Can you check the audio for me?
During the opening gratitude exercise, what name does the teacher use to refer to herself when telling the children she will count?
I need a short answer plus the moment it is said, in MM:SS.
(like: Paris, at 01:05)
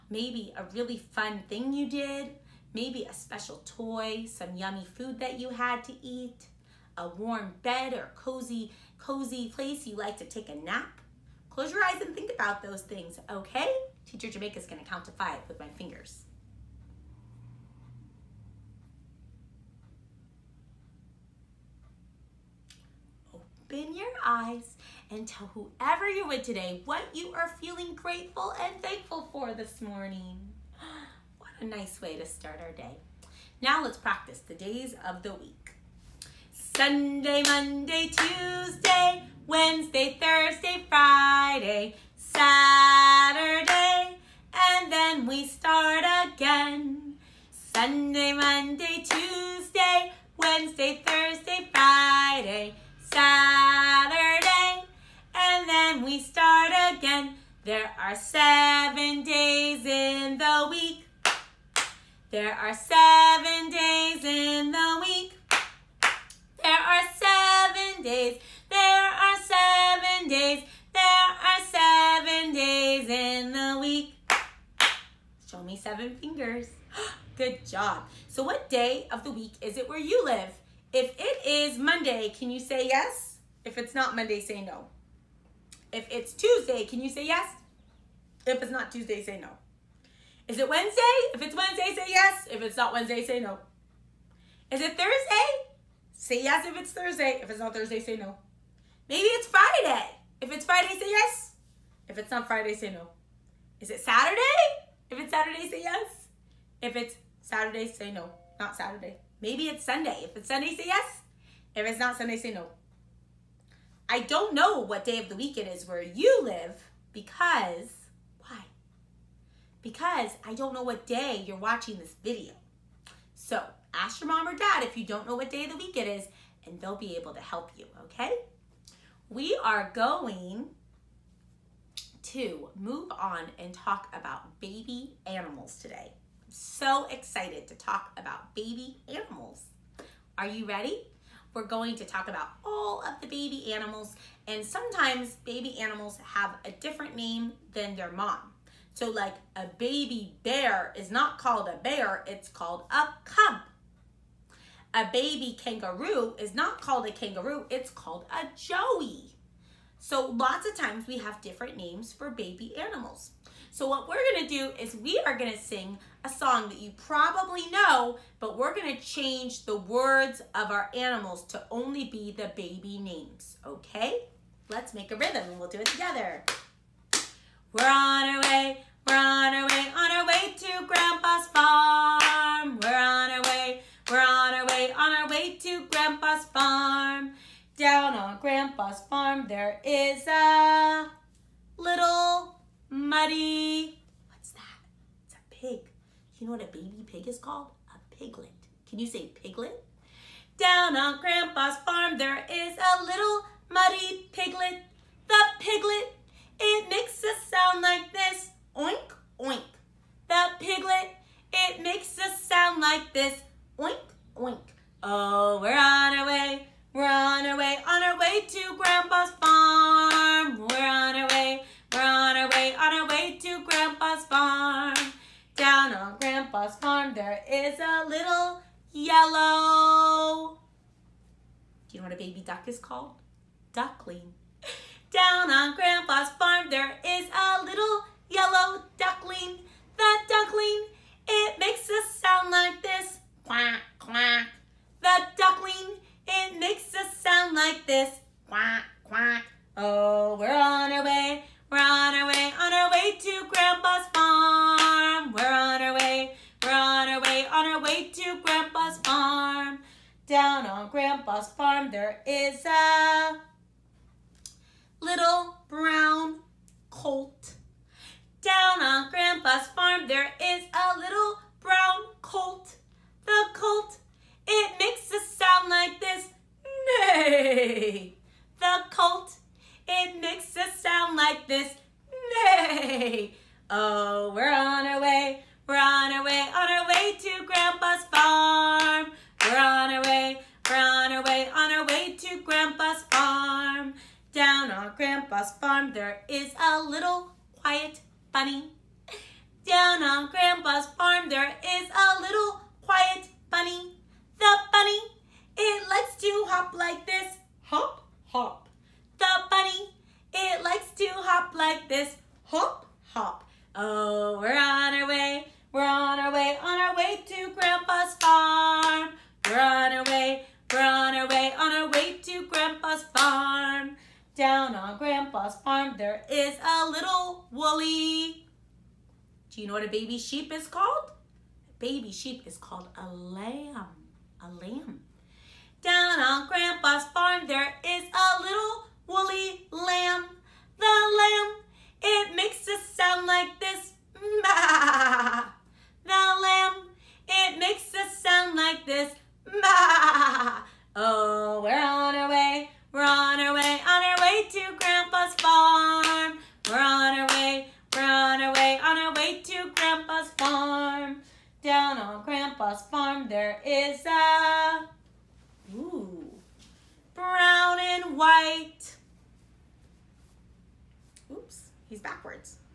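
Jamaica, at 00:14.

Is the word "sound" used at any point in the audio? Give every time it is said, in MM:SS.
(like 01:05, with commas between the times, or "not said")
03:27, 03:32, 04:02, 04:07, 04:35, 04:40, 05:42, 05:48.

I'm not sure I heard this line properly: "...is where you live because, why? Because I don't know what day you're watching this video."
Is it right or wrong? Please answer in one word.
right.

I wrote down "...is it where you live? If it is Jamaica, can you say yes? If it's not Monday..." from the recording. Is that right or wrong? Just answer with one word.
wrong.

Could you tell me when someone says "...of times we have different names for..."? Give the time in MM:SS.
02:40.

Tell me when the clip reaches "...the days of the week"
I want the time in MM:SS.
00:34.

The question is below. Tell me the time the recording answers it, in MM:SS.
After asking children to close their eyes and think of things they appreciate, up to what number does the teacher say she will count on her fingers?
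00:15.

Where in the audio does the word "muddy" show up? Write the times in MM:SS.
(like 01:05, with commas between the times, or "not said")
03:12, 03:23.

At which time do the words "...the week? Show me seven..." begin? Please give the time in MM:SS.
01:13.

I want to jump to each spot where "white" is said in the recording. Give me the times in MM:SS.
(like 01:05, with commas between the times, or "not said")
06:08.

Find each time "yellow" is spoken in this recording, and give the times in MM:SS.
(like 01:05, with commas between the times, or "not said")
03:48, 03:58.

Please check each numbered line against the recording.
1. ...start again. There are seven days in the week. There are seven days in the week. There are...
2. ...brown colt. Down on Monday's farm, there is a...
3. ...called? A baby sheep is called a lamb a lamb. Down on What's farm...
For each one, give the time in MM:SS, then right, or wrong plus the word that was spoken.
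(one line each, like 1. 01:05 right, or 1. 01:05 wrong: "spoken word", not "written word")
1. 00:56 right
2. 04:25 wrong: "Grandpa", not "Monday"
3. 05:30 wrong: "Grandpa", not "What".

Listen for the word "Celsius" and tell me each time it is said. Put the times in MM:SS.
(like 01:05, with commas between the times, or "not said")
not said.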